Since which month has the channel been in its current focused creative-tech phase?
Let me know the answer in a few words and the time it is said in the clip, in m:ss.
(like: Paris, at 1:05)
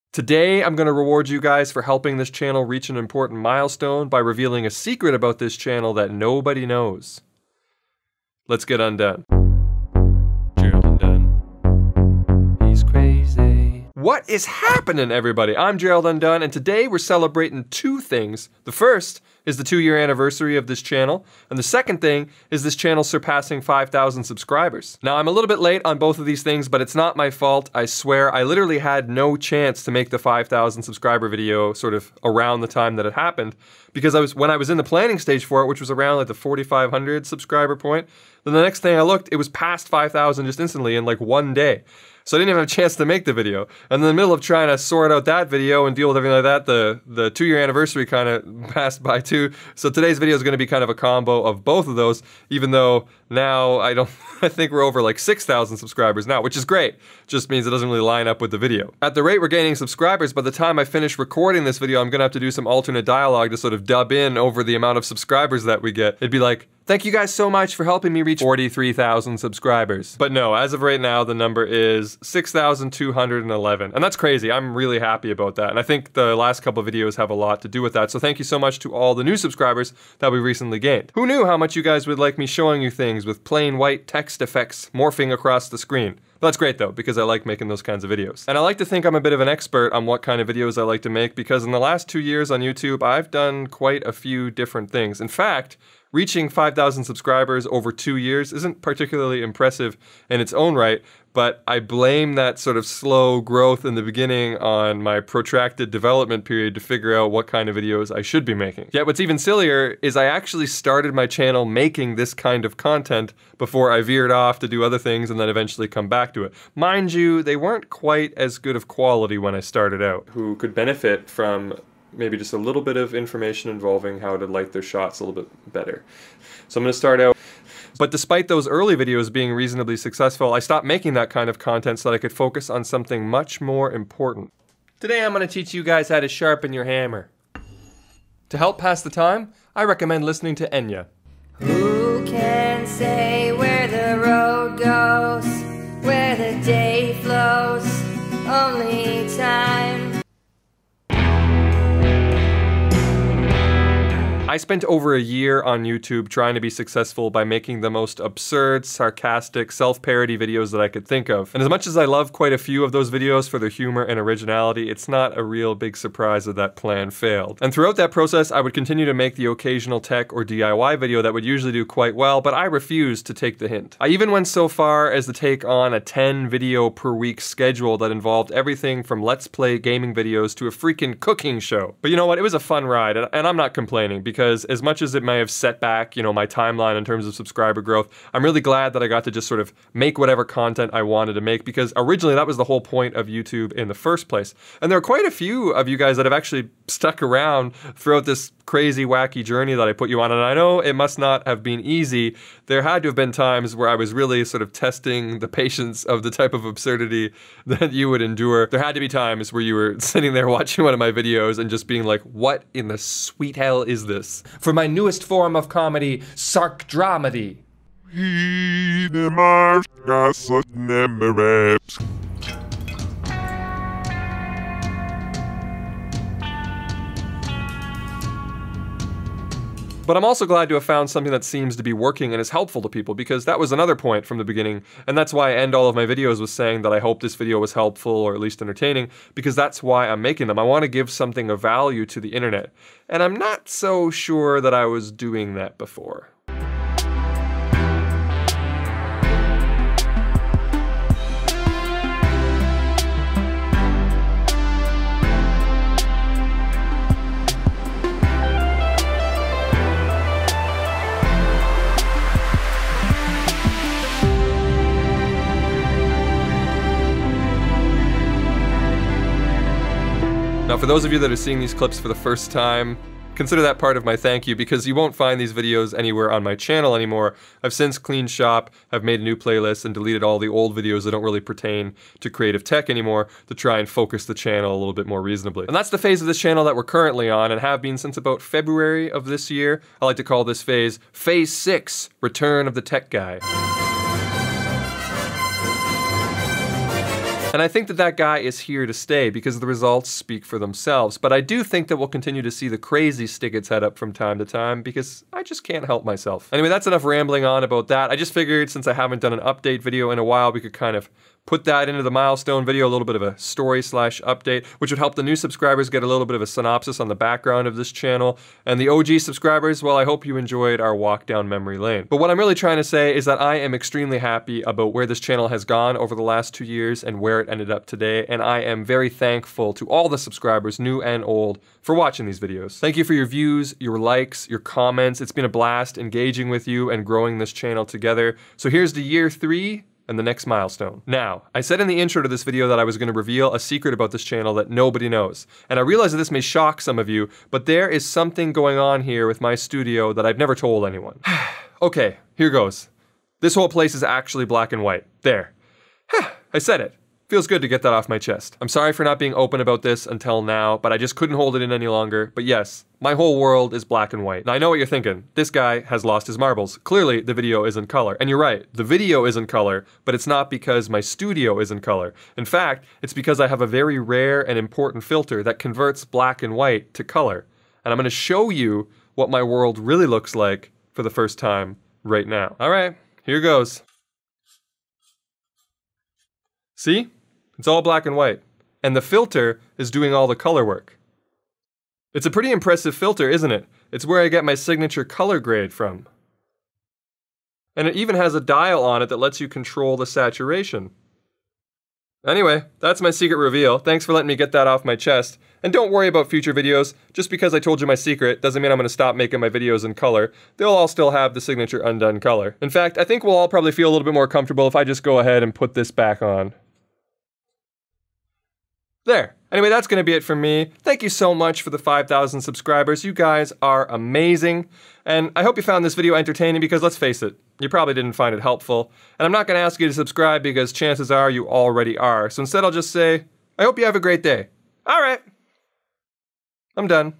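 February, at 4:48.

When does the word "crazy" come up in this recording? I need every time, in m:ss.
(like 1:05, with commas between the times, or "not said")
1:14, 3:18, 5:02.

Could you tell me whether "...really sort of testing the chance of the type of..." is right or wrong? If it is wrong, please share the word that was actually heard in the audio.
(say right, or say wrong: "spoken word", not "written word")
wrong: "patience", not "chance".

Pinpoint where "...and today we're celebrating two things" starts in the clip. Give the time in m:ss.
0:16.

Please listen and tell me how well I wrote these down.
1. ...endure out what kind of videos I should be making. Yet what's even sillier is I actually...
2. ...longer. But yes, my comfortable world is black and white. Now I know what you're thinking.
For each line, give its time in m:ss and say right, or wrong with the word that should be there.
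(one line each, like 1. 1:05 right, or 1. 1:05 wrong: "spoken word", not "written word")
1. 1:46 wrong: "figure", not "endure"
2. 6:01 wrong: "whole", not "comfortable".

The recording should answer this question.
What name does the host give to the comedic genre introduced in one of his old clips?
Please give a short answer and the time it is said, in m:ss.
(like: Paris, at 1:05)
Sark Dramedy, at 3:36.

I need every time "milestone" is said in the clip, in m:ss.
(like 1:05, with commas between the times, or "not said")
0:03, 5:12, 5:40.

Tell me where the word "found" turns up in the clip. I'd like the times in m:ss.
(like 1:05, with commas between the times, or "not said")
3:50, 7:05.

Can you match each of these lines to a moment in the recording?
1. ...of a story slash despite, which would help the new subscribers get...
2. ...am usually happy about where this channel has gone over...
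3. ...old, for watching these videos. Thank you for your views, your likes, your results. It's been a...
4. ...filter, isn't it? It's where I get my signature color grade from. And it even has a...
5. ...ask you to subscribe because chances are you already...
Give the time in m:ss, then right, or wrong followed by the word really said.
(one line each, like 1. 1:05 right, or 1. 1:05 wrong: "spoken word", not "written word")
1. 5:13 wrong: "update", not "despite"
2. 5:23 wrong: "extremely", not "usually"
3. 5:31 wrong: "comments", not "results"
4. 6:32 right
5. 7:09 right.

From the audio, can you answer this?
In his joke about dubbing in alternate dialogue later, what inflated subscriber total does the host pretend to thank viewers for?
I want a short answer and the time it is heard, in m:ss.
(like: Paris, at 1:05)
43,000, at 1:08.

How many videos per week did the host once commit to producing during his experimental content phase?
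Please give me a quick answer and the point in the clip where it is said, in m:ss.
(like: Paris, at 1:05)
10, at 2:56.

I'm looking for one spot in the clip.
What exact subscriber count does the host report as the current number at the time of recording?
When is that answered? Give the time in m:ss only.
1:12.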